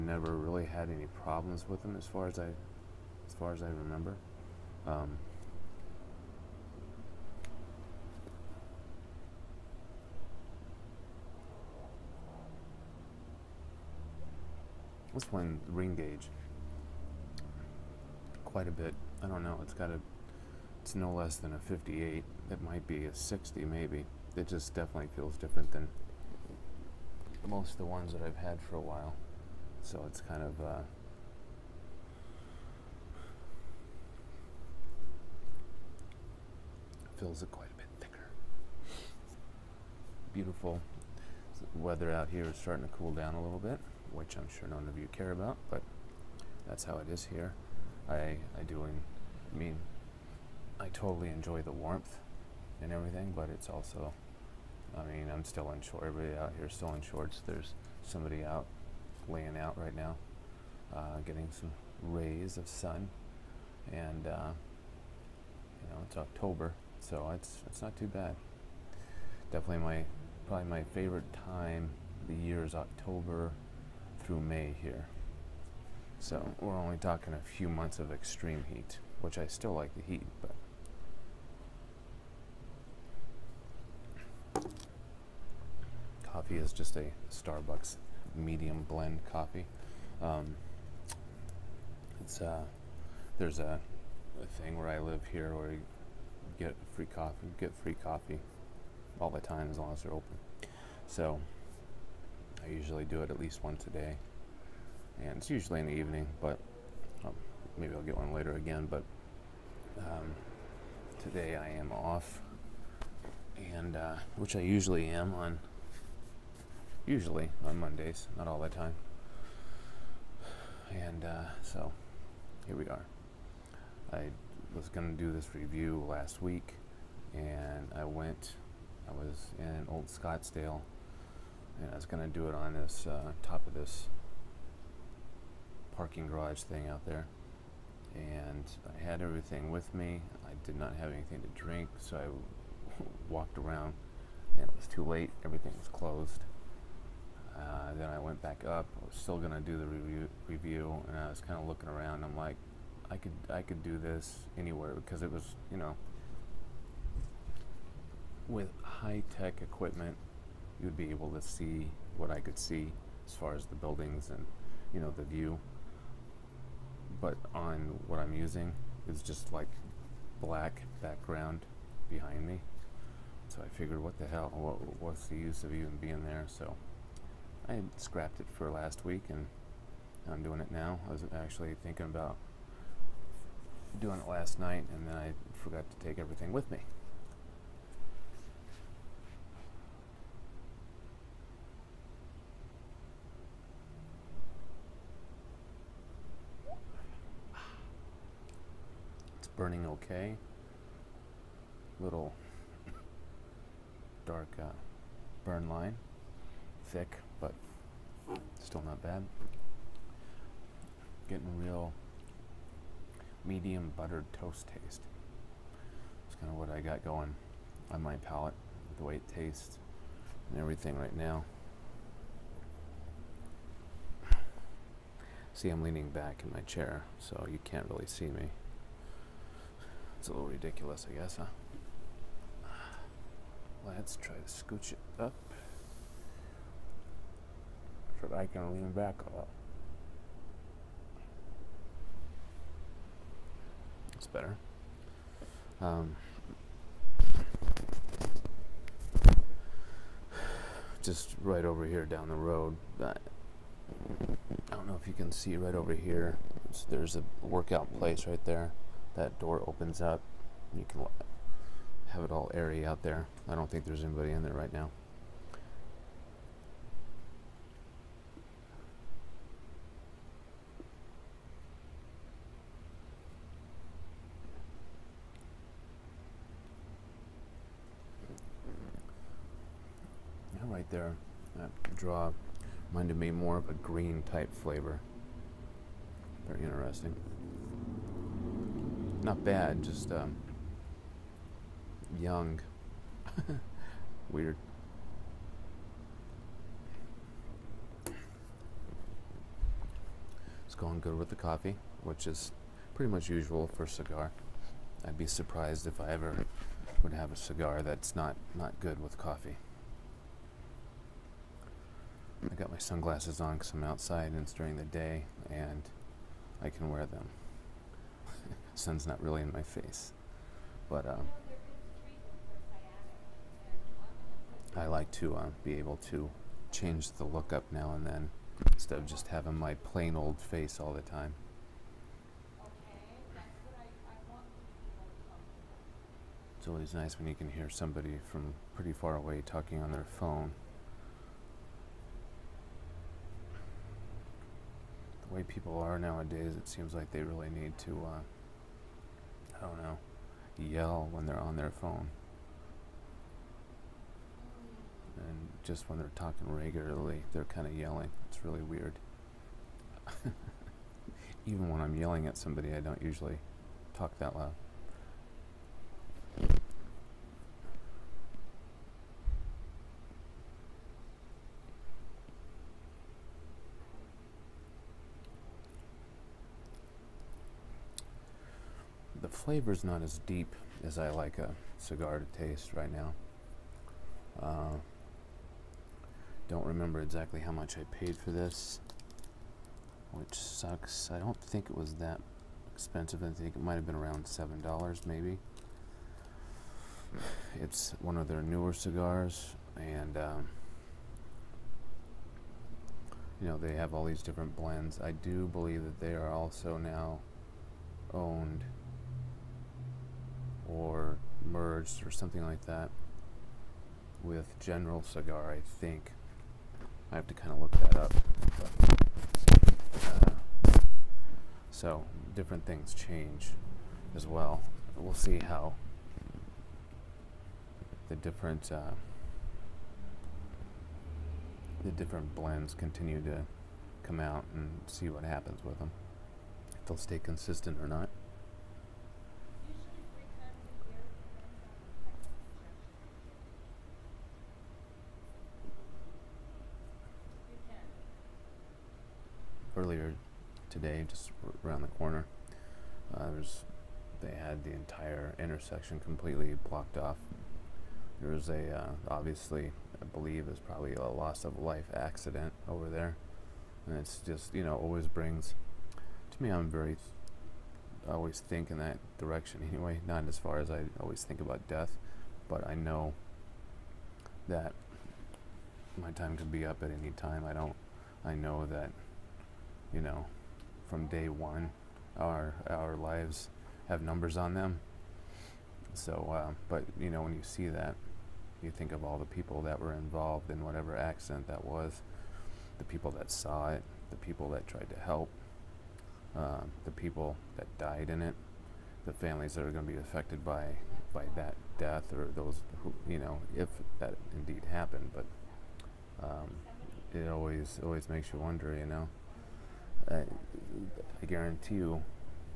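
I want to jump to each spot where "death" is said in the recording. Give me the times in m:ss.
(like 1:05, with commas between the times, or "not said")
7:51, 8:21.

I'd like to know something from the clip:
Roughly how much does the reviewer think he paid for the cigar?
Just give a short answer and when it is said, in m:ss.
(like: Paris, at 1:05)
$7, at 6:34.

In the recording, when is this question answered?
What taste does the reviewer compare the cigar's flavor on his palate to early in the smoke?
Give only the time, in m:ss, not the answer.
3:33.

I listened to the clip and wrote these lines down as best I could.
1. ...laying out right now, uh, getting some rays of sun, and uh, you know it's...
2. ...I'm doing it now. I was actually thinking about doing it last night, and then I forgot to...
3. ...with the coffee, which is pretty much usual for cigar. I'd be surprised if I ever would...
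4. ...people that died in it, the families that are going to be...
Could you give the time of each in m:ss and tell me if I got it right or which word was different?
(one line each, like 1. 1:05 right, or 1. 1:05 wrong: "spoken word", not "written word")
1. 0:59 right
2. 3:00 right
3. 5:01 right
4. 8:16 right.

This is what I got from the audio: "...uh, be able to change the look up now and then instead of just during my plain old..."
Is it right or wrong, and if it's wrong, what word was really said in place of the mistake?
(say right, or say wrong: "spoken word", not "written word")
wrong: "having", not "during".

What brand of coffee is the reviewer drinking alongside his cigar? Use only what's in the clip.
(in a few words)
Starbucks.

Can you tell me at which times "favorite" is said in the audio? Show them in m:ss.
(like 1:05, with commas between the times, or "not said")
1:10.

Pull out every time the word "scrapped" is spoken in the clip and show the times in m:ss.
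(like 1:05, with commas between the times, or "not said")
2:57.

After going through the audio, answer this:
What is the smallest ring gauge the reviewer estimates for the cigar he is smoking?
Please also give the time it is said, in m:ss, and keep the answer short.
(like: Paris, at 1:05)
58, at 0:21.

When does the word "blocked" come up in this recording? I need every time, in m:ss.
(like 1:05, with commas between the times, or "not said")
7:36.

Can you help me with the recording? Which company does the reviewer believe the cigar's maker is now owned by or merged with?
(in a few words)
General Cigar.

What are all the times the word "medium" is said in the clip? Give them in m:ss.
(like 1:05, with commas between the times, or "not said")
1:28, 3:33.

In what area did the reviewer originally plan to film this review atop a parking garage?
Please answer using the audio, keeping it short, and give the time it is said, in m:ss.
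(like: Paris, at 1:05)
Old Scottsdale, at 2:09.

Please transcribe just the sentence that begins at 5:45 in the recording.
The way people are nowadays, it seems like they really need to uh, I don't know, yell when they're on their phone.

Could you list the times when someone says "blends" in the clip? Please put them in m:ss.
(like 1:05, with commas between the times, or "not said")
1:28, 6:44, 7:12.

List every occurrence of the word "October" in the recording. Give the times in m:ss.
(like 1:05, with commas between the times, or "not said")
1:06, 1:12.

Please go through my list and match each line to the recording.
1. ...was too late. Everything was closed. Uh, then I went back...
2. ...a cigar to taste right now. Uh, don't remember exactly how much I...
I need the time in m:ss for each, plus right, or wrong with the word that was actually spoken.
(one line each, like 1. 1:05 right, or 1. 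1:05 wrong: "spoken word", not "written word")
1. 2:24 right
2. 6:21 right.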